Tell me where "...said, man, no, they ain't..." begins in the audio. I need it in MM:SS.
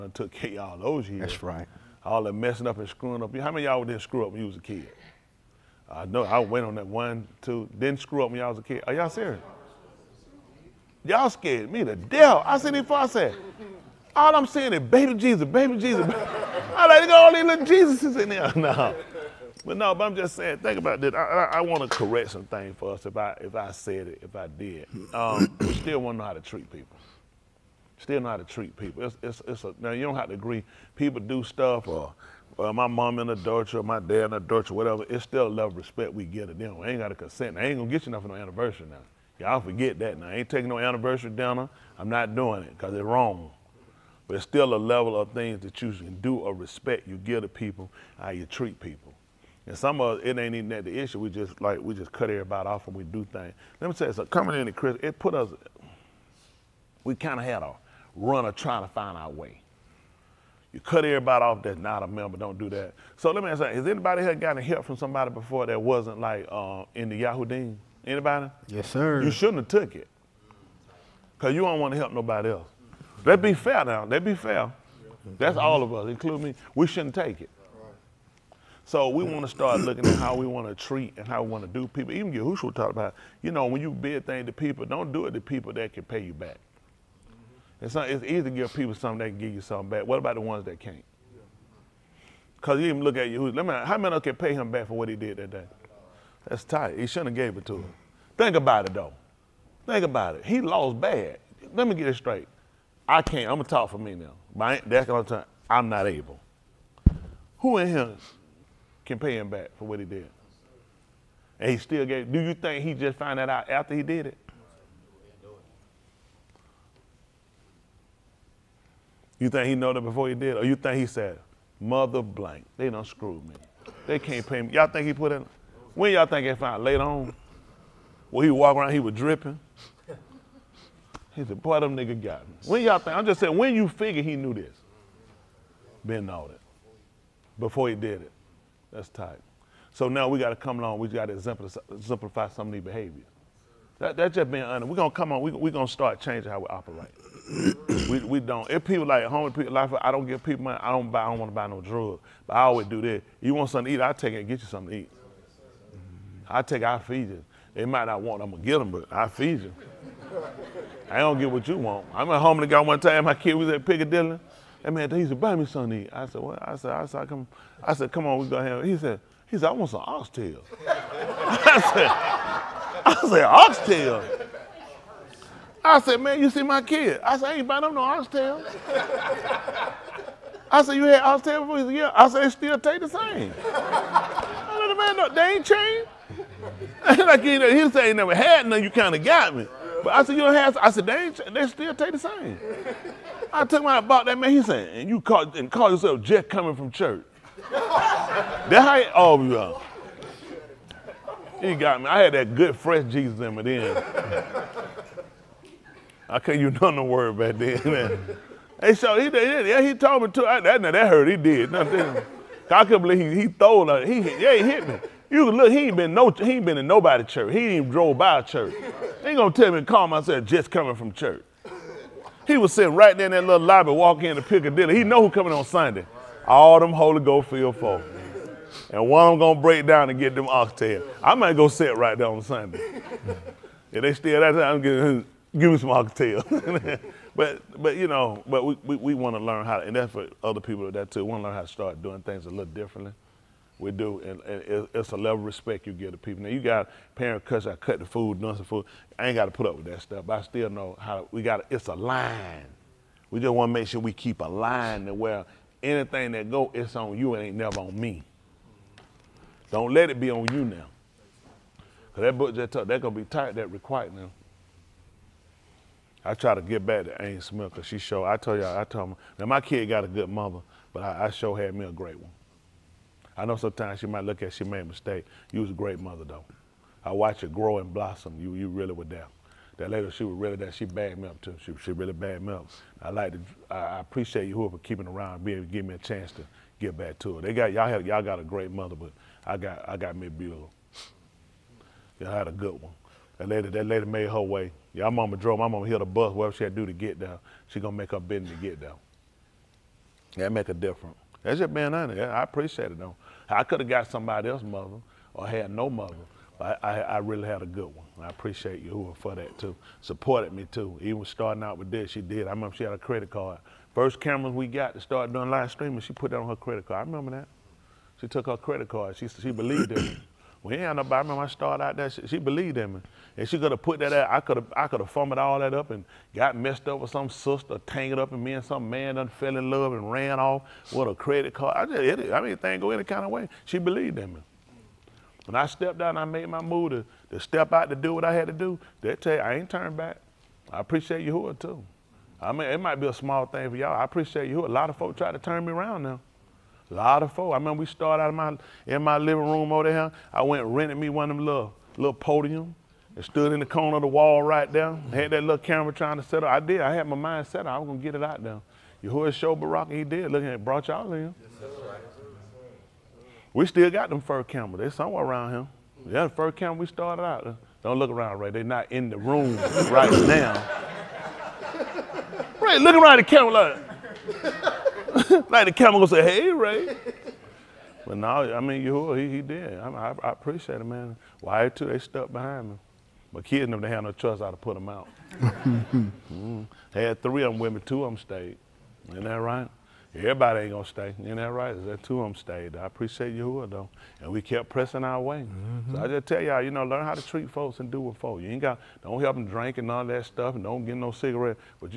03:04.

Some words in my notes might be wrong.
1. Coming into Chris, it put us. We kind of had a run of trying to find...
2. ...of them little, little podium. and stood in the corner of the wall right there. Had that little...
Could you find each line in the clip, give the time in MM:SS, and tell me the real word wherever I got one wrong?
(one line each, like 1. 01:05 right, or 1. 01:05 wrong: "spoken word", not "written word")
1. 00:54 right
2. 05:51 right.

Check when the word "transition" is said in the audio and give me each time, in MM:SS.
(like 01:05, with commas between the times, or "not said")
not said.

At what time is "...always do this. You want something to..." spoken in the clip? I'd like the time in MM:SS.
02:32.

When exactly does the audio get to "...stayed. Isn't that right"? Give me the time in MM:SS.
06:28.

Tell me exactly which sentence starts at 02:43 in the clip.
My kid was at Piccadilly that man, he said buy me Sunday.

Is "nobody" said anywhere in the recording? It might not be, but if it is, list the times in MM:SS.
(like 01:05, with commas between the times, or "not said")
01:12, 03:36, 05:20.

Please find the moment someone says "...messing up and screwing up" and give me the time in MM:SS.
00:02.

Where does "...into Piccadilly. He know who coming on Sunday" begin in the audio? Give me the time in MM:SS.
03:44.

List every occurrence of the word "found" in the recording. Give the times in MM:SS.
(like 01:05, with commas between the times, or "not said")
01:53, 02:06.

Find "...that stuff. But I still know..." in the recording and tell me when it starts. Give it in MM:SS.
04:09.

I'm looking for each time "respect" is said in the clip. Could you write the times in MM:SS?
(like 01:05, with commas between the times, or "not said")
00:35, 00:46, 04:05.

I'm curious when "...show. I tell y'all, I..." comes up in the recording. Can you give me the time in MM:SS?
04:27.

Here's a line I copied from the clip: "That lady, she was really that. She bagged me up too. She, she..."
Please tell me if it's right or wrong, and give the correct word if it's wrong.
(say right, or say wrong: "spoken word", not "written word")
right.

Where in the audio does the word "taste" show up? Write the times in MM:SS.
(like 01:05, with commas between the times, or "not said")
03:02, 03:11.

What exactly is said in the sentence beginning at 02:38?
I'm gonna get them, but I feed you.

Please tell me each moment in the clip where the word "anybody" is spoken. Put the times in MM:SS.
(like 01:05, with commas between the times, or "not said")
01:03, 01:08.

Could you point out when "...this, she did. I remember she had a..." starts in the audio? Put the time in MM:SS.
05:11.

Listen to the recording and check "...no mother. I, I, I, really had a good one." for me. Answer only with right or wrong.
right.